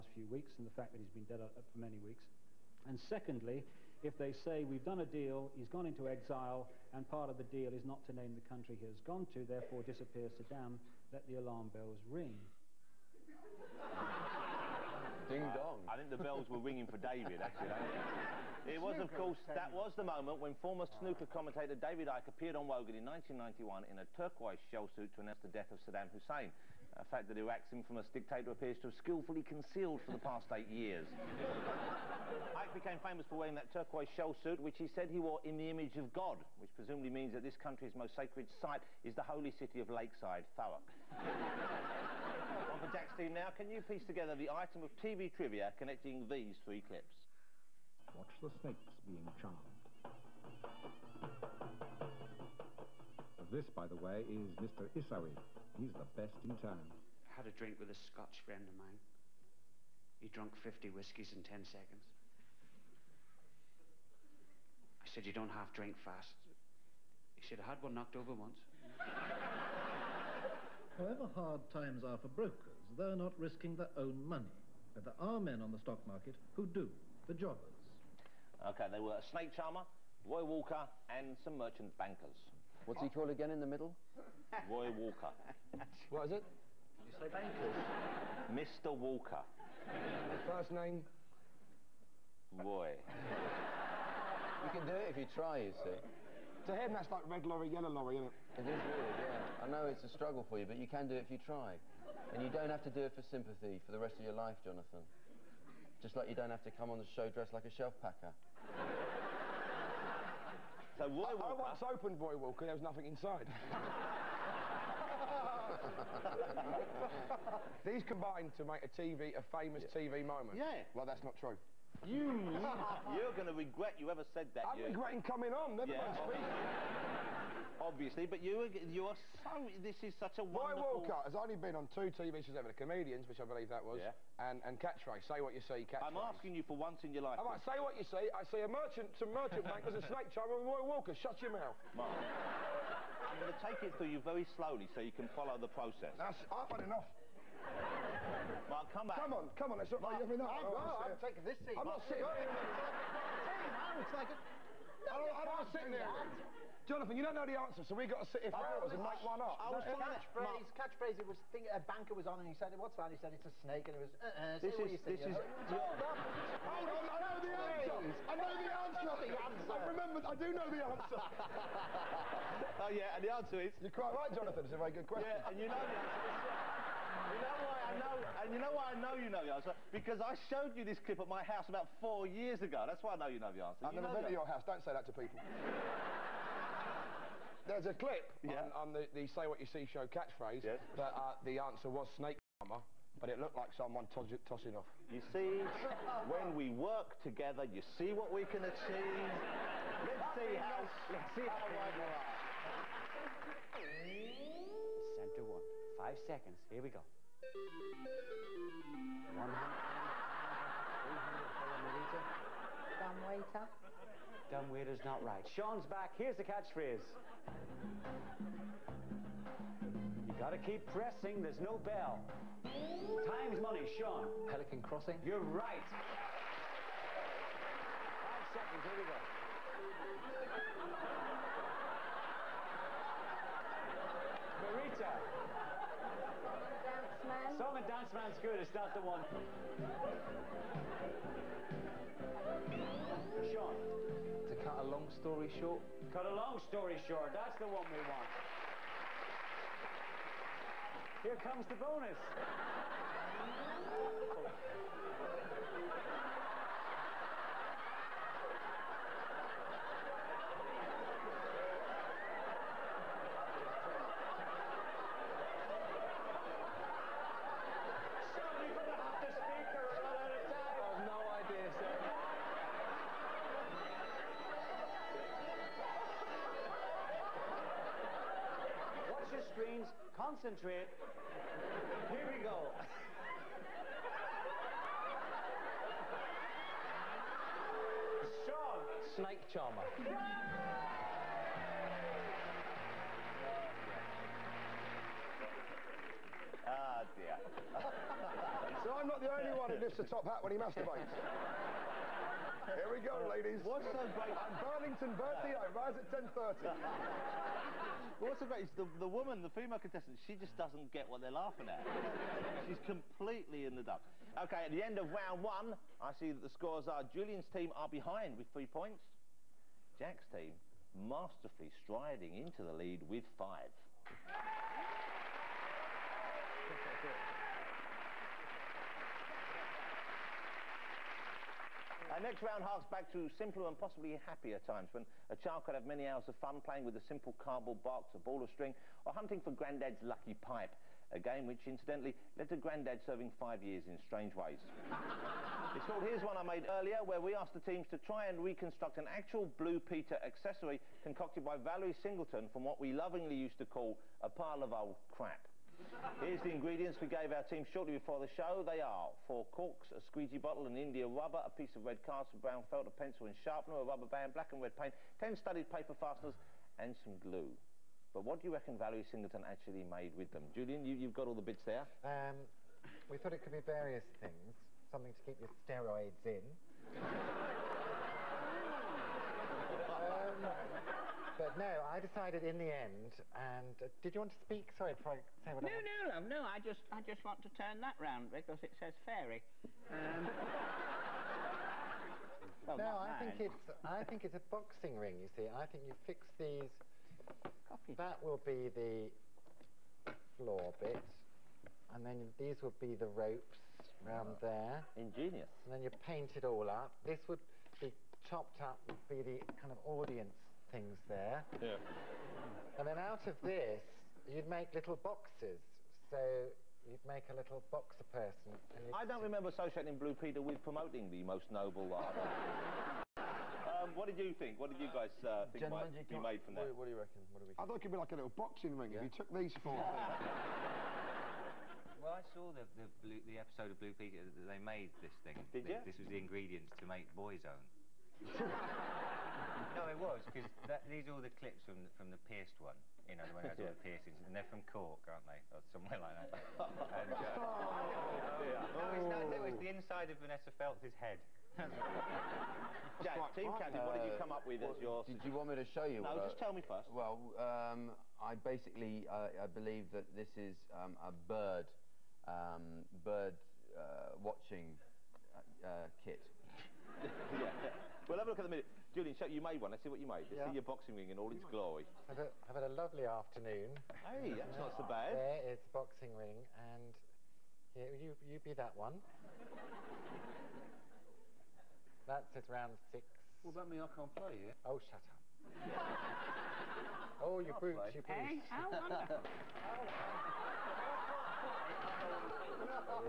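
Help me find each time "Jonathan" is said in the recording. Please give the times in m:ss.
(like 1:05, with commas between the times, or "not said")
1:44, 2:36, 2:54.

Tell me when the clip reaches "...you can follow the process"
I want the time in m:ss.
2:25.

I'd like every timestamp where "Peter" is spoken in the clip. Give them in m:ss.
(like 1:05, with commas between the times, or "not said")
5:49, 7:00, 7:13.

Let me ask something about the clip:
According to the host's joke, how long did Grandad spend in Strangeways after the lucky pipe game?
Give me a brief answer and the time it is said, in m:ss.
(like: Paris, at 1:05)
5 years, at 5:43.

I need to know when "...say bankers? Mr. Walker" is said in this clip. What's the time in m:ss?
1:27.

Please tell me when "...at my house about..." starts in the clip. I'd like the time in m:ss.
3:01.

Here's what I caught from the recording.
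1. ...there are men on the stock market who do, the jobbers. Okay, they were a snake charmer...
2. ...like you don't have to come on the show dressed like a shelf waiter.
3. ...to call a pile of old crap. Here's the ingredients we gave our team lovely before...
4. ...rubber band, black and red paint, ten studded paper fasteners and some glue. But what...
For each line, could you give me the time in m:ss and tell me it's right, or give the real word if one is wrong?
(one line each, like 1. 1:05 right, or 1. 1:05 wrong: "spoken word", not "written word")
1. 1:15 right
2. 1:46 wrong: "packer", not "waiter"
3. 5:53 wrong: "shortly", not "lovely"
4. 6:03 right.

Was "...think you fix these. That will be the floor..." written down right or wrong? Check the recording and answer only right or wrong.
right.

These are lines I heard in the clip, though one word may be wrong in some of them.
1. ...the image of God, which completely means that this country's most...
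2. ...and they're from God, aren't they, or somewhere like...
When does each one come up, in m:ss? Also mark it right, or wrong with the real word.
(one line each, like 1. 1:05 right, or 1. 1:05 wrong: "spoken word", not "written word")
1. 0:35 wrong: "presumably", not "completely"
2. 7:24 wrong: "Cork", not "God".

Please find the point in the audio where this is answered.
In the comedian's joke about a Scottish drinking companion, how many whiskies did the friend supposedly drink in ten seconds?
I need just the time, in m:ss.
1:00.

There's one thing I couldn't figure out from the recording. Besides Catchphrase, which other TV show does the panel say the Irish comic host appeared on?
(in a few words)
The Comedians.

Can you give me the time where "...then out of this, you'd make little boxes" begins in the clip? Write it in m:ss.
6:52.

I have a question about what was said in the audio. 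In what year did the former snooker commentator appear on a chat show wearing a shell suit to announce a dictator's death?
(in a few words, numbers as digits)
1991.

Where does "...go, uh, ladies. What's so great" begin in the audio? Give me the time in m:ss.
5:03.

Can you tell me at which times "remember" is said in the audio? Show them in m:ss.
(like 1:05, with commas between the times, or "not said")
2:49, 6:59.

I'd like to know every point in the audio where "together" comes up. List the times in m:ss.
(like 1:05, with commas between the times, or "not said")
0:44, 3:17.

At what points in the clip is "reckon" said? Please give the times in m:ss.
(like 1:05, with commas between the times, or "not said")
6:08, 7:06.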